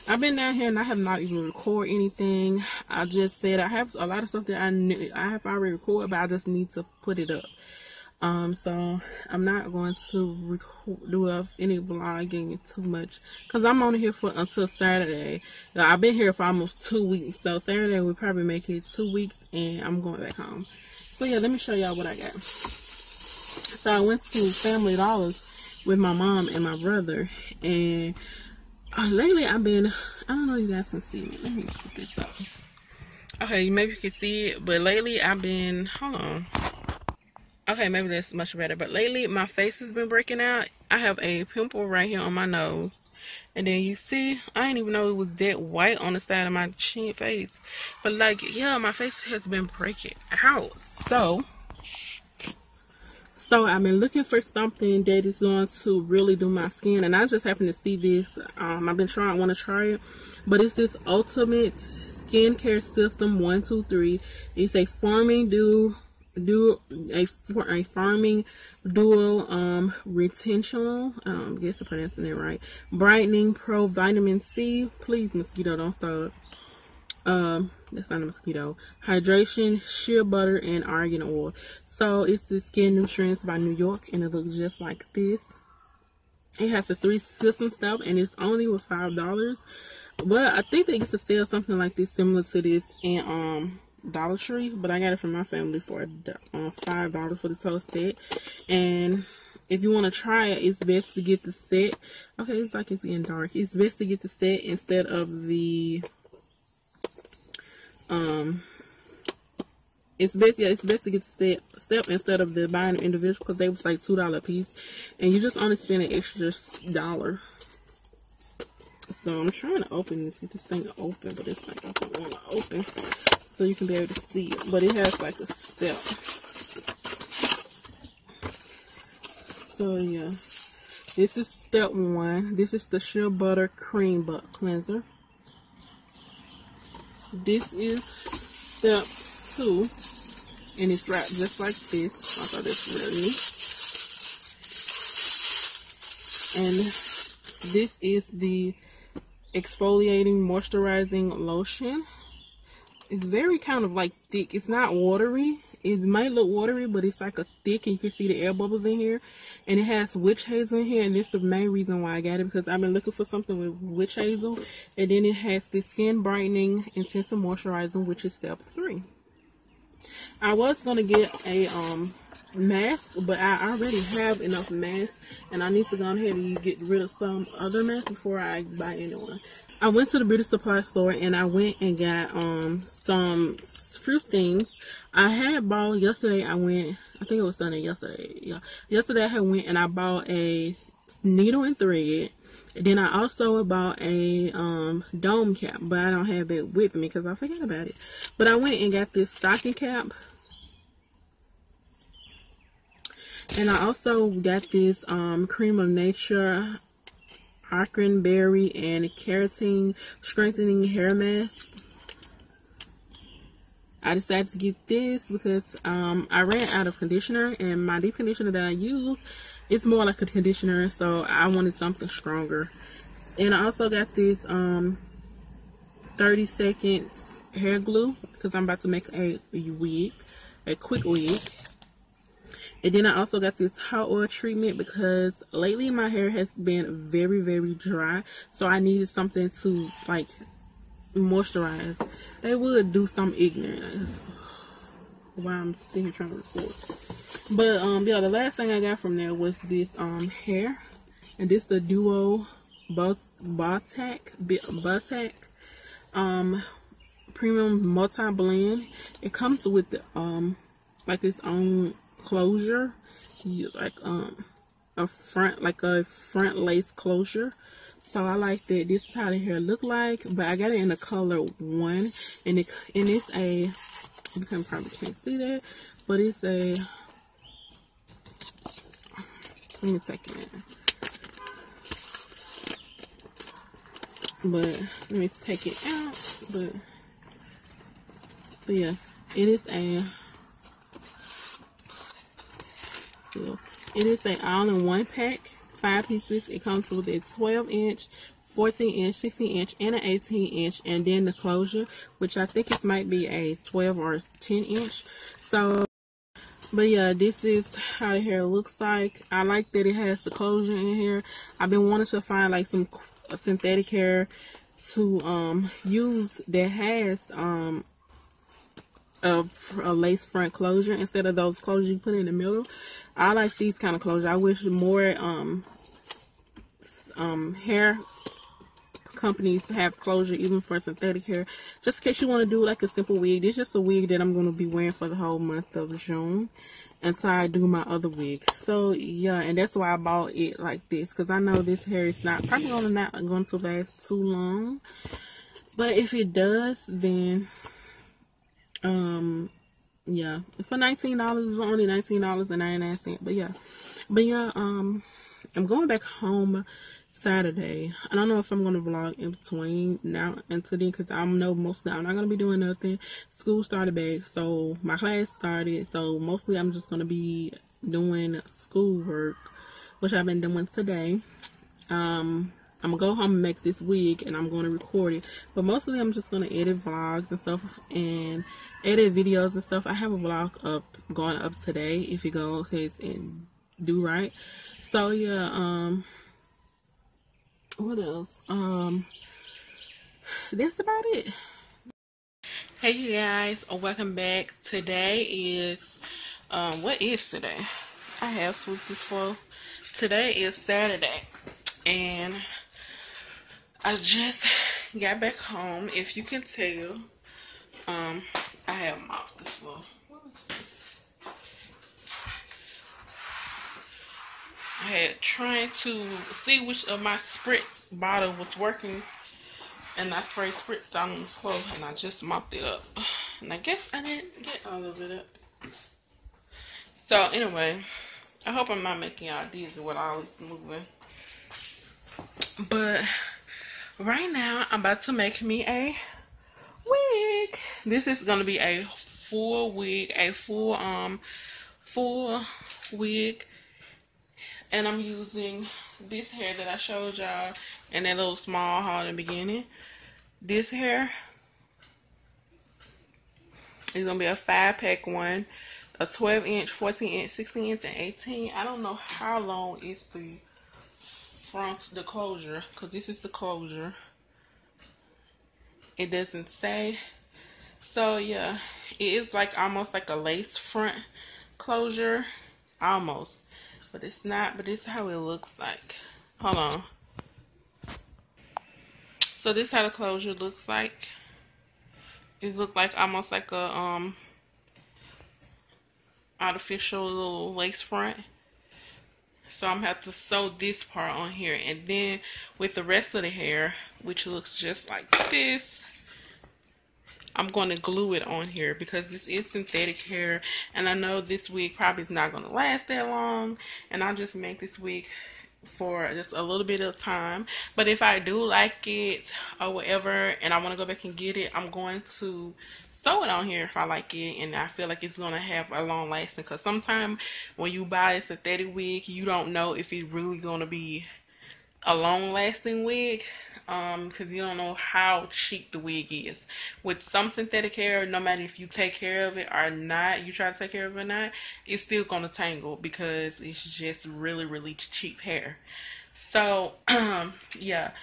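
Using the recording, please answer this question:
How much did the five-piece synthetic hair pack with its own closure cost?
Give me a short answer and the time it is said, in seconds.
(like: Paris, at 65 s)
$19.99, at 351 s.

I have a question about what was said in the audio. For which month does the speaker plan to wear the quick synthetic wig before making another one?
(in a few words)
June.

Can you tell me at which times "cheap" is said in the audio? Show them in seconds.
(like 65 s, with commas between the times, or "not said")
525 s, 534 s.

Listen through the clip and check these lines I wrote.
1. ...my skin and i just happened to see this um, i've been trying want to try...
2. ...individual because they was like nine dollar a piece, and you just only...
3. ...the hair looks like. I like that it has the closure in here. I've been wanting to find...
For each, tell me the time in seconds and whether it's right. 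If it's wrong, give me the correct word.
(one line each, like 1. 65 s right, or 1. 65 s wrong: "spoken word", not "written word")
1. 56 s right
2. 112 s wrong: "two", not "nine"
3. 308 s right.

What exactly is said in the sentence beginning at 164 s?
And then it has the skin brightening intensive moisturizing, which is step three.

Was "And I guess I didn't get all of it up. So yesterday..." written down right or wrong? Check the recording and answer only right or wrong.
wrong.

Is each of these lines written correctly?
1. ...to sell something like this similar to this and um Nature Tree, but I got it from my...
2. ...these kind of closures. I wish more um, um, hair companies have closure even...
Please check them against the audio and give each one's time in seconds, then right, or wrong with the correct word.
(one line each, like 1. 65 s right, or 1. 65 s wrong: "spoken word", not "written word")
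1. 91 s wrong: "Dollar", not "Nature"
2. 323 s right.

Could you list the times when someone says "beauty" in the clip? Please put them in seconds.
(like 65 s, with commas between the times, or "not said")
180 s.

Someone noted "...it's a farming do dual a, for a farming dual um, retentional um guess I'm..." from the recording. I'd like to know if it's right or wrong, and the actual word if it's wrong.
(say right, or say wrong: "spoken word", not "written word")
wrong: "forming", not "farming".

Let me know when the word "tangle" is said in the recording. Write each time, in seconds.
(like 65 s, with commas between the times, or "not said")
532 s.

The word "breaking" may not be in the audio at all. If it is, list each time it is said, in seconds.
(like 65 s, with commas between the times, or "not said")
40 s, 49 s.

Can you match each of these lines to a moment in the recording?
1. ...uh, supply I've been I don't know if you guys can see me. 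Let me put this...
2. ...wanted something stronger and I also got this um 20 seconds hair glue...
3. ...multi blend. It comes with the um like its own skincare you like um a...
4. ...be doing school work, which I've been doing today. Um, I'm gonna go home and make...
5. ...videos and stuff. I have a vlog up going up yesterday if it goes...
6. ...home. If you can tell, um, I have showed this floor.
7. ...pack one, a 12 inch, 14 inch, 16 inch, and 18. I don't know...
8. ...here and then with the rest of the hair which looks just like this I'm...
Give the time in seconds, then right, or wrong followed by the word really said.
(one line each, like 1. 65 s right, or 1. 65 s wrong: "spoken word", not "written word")
1. 28 s wrong: "lately", not "supply"
2. 221 s wrong: "30", not "20"
3. 257 s wrong: "closure", not "skincare"
4. 367 s right
5. 379 s wrong: "today", not "yesterday"
6. 405 s wrong: "mopped", not "showed"
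7. 454 s right
8. 491 s right.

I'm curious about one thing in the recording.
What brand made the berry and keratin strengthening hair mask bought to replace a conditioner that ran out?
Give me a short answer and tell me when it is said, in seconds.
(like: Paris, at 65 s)
Cream of Nature, at 205 s.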